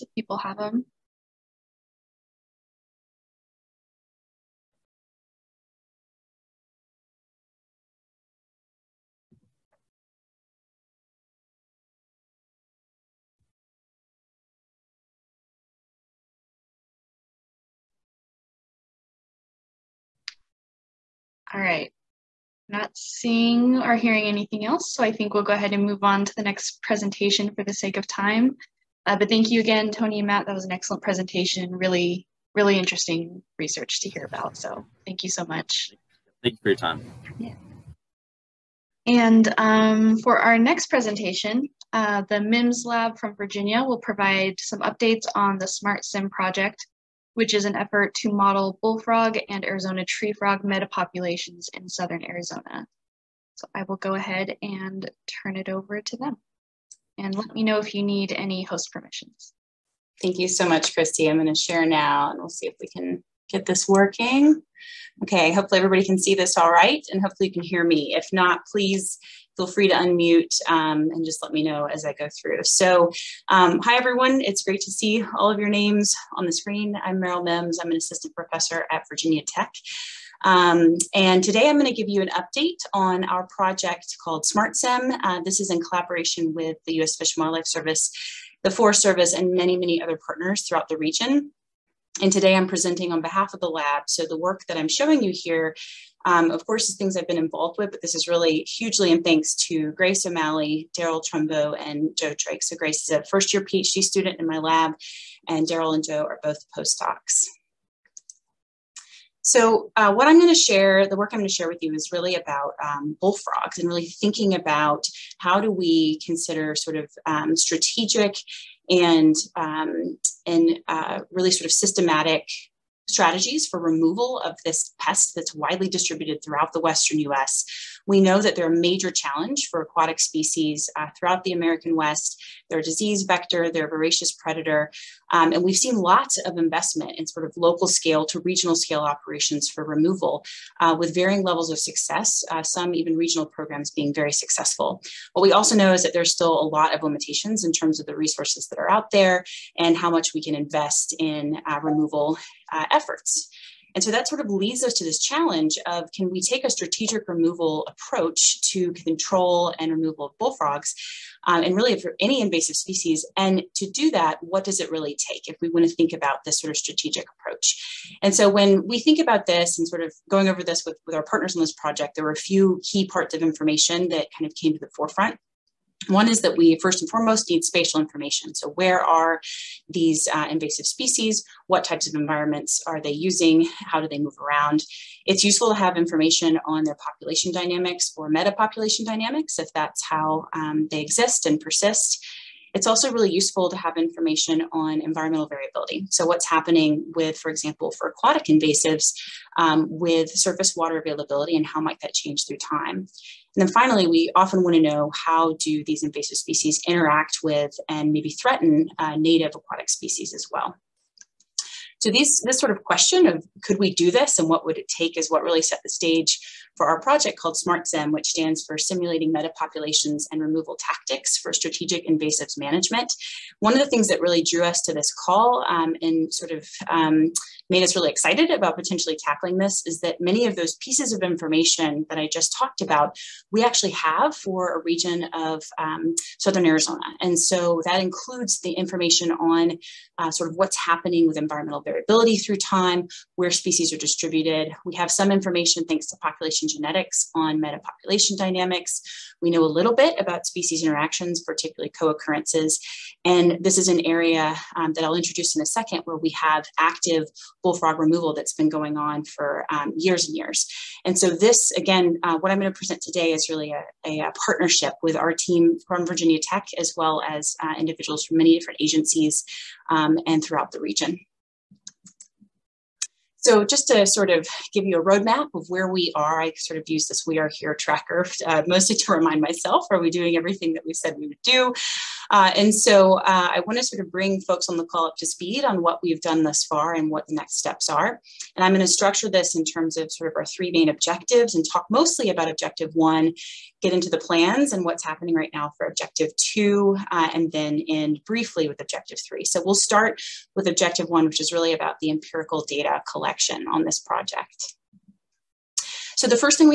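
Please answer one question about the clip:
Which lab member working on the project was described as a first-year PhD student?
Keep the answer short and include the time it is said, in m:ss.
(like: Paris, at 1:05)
Grace O'Malley, at 1:42.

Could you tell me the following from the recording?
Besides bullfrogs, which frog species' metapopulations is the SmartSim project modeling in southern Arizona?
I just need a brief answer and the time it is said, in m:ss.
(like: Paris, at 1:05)
Arizona tree frog, at 0:49.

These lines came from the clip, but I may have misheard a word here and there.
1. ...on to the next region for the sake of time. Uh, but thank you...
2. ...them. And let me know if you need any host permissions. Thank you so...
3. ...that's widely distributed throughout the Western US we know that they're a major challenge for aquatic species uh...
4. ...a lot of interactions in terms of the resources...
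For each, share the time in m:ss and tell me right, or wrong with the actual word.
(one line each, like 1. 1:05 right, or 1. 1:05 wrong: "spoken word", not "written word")
1. 0:26 wrong: "presentation", not "region"
2. 0:56 right
3. 2:05 right
4. 2:26 wrong: "limitations", not "interactions".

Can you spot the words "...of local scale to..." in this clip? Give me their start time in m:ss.
2:17.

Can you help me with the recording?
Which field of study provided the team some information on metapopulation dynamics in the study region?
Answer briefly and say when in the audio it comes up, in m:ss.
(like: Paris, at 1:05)
population genetics, at 4:06.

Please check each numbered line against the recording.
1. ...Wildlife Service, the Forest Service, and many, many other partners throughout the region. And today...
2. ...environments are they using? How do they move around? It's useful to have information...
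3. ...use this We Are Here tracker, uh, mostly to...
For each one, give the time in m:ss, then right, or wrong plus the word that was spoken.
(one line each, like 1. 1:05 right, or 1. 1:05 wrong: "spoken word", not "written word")
1. 1:27 right
2. 3:02 right
3. 4:36 right.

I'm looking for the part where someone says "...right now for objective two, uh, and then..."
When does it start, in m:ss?
4:55.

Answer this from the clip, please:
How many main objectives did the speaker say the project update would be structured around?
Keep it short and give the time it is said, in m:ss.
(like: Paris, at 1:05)
3, at 4:50.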